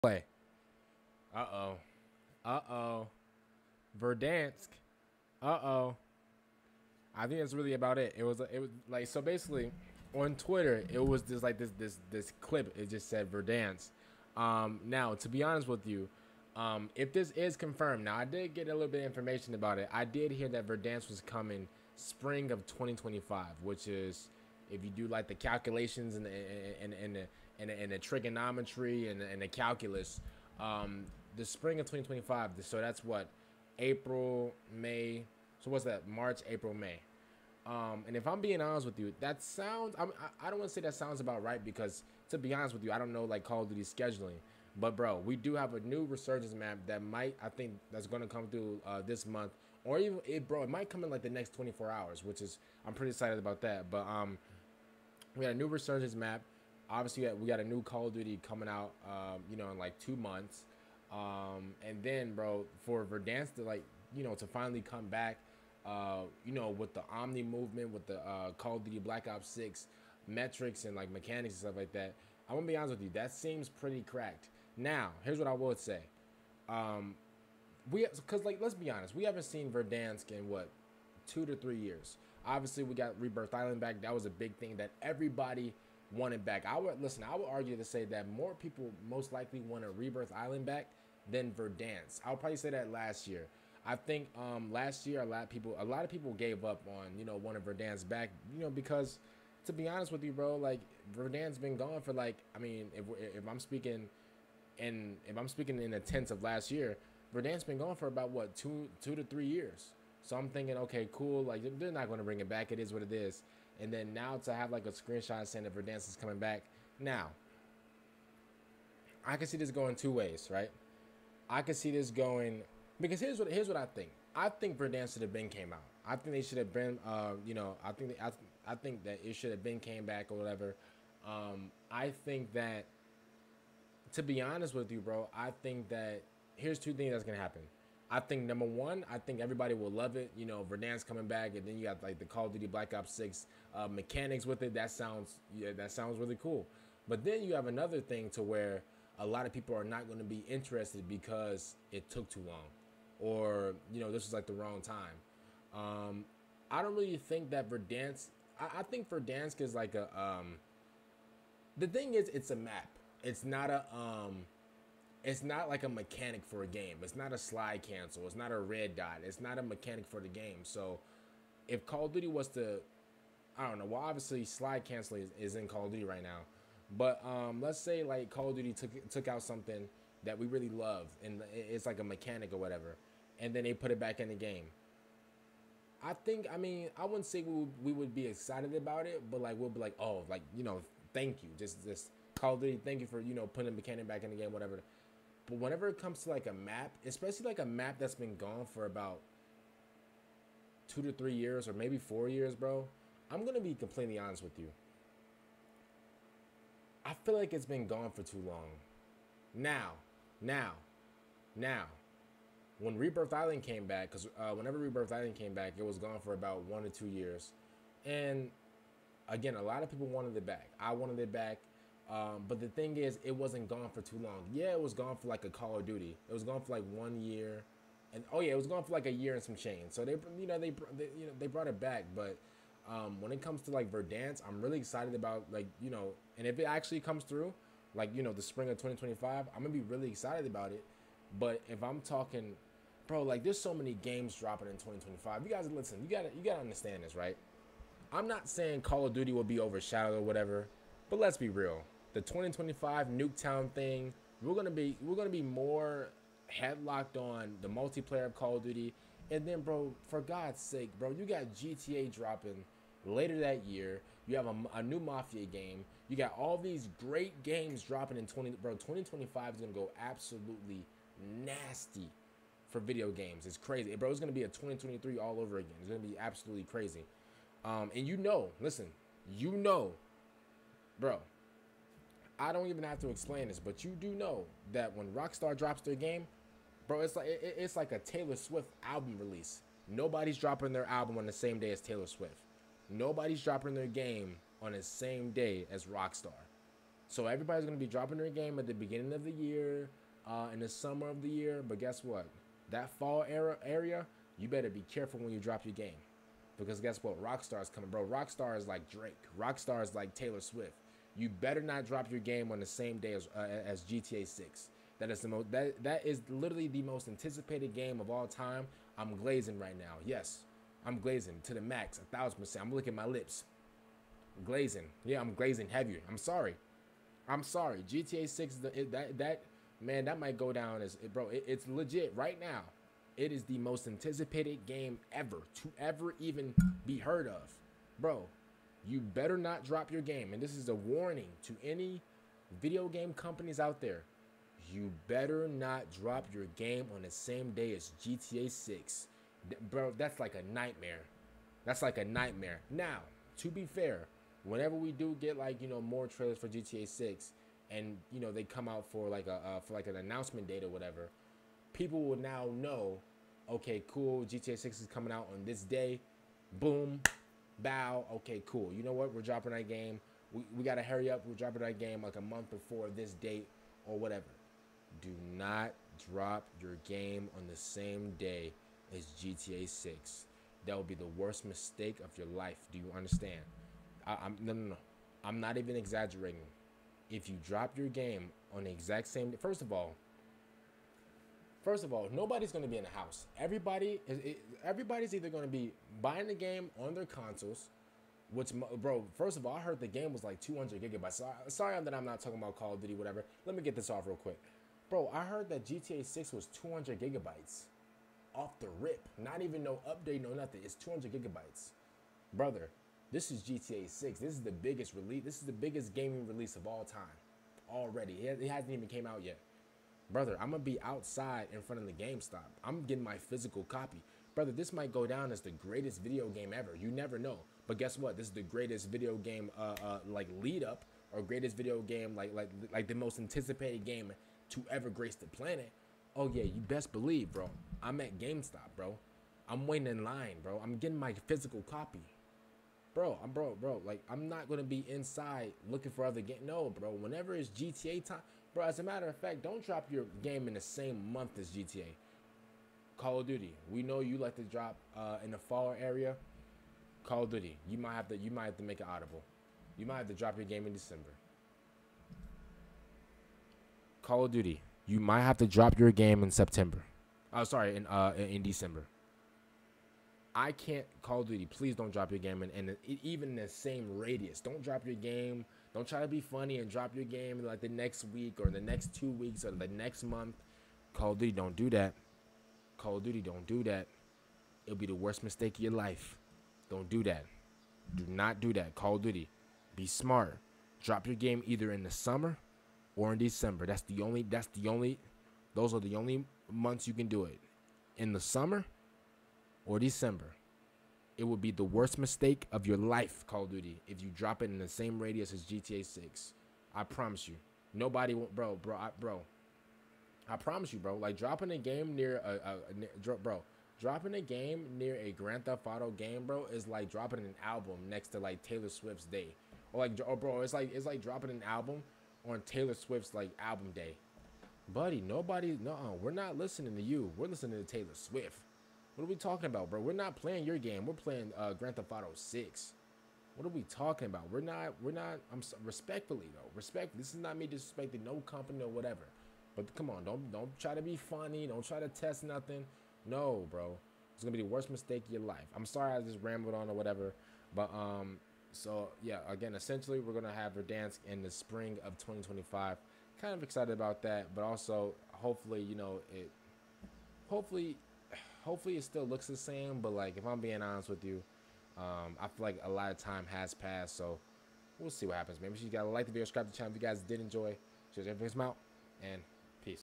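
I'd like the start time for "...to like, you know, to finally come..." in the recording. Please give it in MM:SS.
01:03.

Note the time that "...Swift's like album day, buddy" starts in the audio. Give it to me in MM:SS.
08:42.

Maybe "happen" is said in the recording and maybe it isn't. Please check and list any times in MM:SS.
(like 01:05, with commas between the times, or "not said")
02:17, 09:25.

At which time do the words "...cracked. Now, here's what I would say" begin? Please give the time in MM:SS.
01:14.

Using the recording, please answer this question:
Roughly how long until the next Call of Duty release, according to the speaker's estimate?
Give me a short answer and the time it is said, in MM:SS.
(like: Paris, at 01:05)
Two months, at 00:59.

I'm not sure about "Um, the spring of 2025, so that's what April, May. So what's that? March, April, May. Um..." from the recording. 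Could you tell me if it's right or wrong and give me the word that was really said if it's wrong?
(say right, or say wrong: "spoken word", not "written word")
right.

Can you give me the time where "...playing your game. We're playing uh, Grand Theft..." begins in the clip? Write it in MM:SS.
08:50.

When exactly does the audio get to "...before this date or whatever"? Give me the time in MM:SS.
06:12.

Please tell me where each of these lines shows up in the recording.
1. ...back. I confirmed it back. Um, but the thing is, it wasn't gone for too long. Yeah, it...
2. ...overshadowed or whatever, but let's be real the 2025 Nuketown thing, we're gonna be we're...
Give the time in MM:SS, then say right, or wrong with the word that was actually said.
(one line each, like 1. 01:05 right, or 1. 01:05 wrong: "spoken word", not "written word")
1. 03:40 wrong: "wanted", not "confirmed"
2. 04:09 right.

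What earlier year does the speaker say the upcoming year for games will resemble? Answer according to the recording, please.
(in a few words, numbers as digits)
2023.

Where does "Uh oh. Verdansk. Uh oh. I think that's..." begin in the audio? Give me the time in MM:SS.
00:02.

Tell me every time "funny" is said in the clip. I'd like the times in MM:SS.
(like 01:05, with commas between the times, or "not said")
07:56, 09:00.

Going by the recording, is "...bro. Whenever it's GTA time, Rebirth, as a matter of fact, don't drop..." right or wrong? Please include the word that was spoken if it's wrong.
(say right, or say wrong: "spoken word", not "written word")
wrong: "Bro", not "Rebirth".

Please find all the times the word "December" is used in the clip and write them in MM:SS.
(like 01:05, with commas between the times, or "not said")
07:40, 07:48, 08:13, 08:19.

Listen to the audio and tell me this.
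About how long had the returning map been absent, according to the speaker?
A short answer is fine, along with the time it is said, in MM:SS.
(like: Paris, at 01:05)
One to two years, at 03:36.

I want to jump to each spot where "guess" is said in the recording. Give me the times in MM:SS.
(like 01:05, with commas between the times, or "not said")
05:01, 05:06, 07:07.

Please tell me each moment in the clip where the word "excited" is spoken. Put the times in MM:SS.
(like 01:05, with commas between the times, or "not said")
00:53, 03:08, 03:54, 04:00, 09:13.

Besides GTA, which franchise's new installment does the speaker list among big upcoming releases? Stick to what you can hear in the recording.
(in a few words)
Mafia.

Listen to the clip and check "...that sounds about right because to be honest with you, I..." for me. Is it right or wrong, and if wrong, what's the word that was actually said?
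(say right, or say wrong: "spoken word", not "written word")
right.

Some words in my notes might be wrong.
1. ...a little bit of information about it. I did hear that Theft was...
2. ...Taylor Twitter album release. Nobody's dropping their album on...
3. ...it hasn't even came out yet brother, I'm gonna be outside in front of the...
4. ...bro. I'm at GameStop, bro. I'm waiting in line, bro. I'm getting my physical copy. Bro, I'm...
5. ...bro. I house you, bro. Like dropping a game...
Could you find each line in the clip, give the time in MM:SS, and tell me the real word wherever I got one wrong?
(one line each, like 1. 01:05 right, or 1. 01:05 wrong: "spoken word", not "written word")
1. 00:18 wrong: "Verdansk", not "Theft"
2. 04:47 wrong: "Swift", not "Twitter"
3. 06:58 right
4. 07:17 right
5. 08:28 wrong: "promise", not "house".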